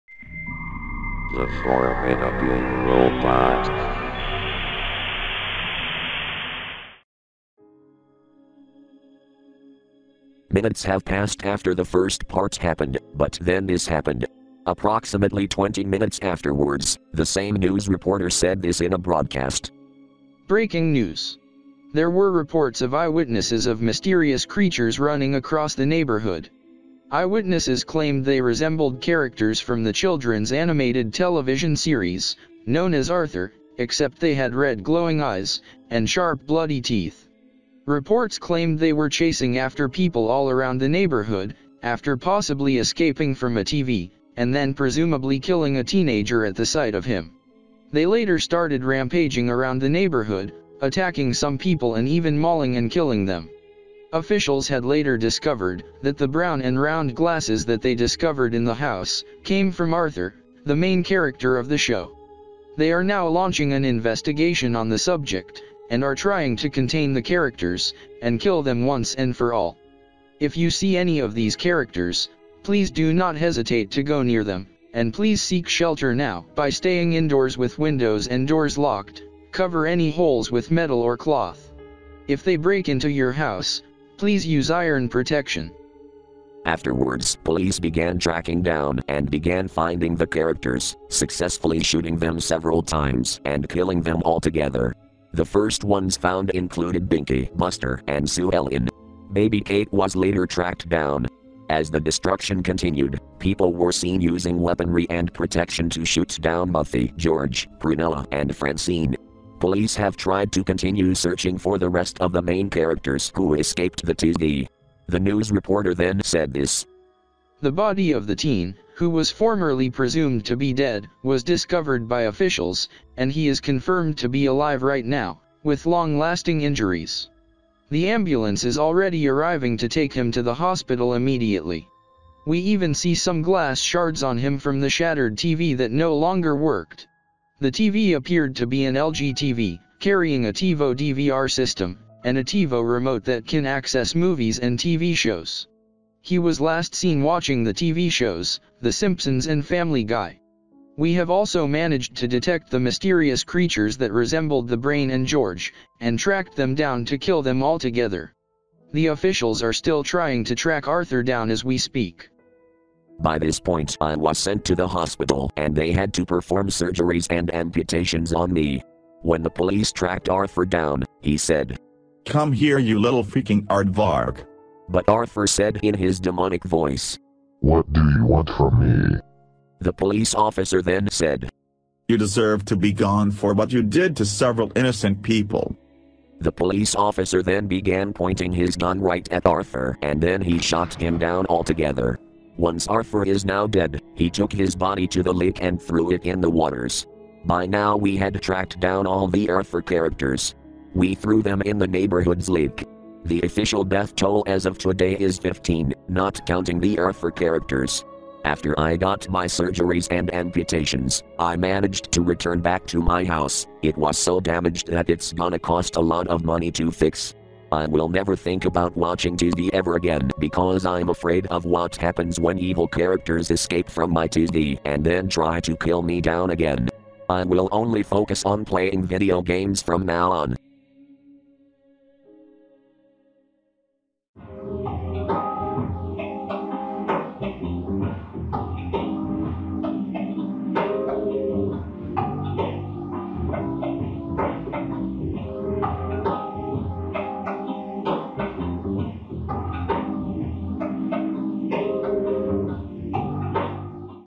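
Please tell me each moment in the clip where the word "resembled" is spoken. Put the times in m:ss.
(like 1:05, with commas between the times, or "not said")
0:28, 2:34.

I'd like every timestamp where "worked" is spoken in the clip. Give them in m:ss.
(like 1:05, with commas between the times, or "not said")
2:16.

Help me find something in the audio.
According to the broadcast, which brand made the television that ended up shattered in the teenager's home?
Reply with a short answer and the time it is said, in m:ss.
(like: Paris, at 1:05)
LG, at 2:18.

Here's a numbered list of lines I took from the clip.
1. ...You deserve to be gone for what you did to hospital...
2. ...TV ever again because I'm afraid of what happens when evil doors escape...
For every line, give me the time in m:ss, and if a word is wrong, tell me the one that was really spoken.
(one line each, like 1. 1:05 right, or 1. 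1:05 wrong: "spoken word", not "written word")
1. 3:02 wrong: "several", not "hospital"
2. 3:39 wrong: "characters", not "doors".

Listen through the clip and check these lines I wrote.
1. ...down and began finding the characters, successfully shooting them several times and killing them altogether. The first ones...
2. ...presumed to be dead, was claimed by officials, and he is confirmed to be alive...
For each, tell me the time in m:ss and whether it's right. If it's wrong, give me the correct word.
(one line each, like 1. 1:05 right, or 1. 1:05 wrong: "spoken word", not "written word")
1. 1:28 right
2. 1:59 wrong: "discovered", not "claimed".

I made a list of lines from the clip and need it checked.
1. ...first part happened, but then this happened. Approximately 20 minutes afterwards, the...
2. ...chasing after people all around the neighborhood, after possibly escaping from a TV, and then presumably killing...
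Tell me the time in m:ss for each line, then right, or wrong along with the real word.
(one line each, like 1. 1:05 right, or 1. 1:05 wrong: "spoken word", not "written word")
1. 0:11 right
2. 0:39 right.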